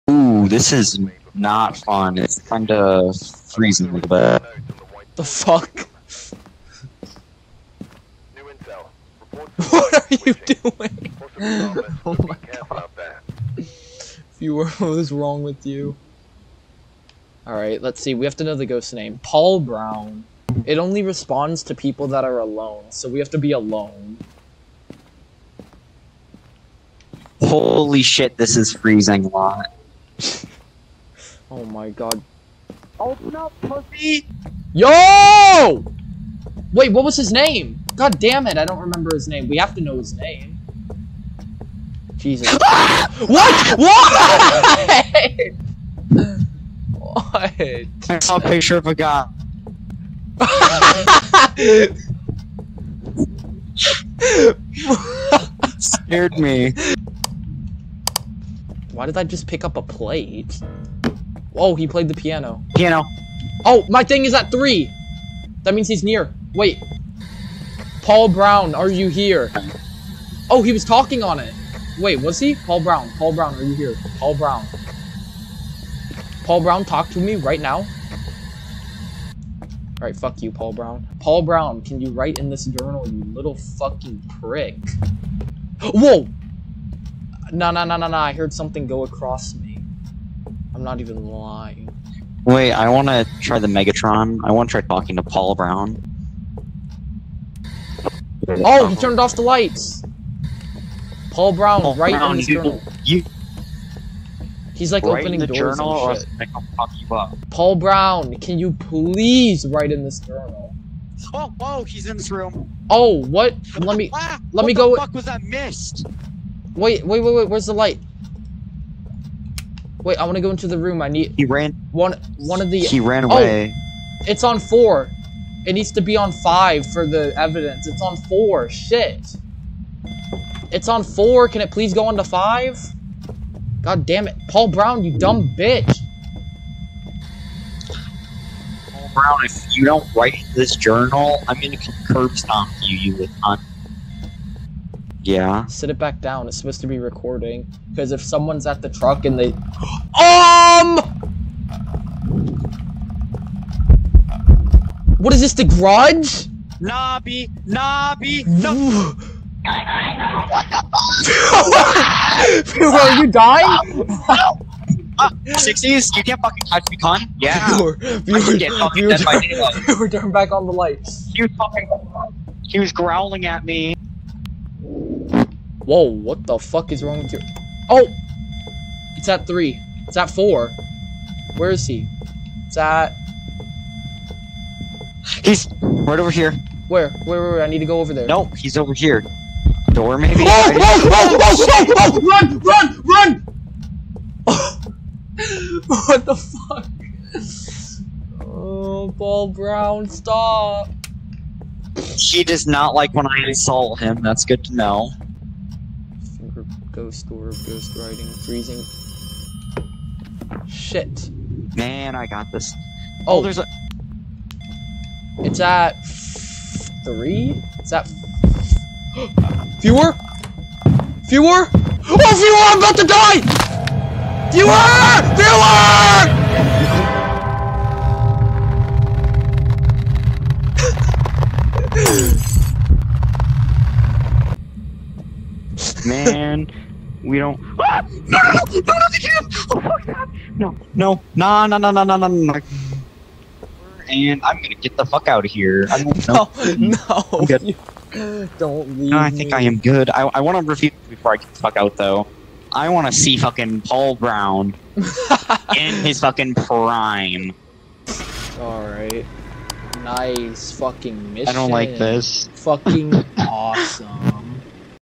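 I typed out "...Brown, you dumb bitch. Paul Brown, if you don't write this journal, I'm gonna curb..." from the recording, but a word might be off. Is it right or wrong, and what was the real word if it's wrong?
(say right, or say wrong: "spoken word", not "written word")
right.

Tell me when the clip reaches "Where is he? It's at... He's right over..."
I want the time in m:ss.
3:01.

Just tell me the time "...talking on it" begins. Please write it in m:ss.
1:10.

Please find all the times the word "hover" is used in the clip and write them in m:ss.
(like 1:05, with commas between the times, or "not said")
not said.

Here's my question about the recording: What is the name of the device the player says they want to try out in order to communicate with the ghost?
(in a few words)
Megatron.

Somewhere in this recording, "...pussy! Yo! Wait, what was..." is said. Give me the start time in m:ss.
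0:33.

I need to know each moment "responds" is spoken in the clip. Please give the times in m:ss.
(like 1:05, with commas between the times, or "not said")
0:21.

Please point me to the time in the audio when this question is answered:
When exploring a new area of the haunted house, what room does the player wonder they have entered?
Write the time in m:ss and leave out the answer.
2:35.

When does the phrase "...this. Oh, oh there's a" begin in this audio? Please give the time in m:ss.
3:32.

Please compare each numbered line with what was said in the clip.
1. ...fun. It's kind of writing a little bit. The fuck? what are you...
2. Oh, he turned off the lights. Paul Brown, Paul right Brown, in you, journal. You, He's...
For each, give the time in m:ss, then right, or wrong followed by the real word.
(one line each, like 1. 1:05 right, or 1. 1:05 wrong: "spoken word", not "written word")
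1. 0:01 wrong: "freezing", not "writing"
2. 1:38 right.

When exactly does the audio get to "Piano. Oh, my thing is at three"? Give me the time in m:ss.
1:02.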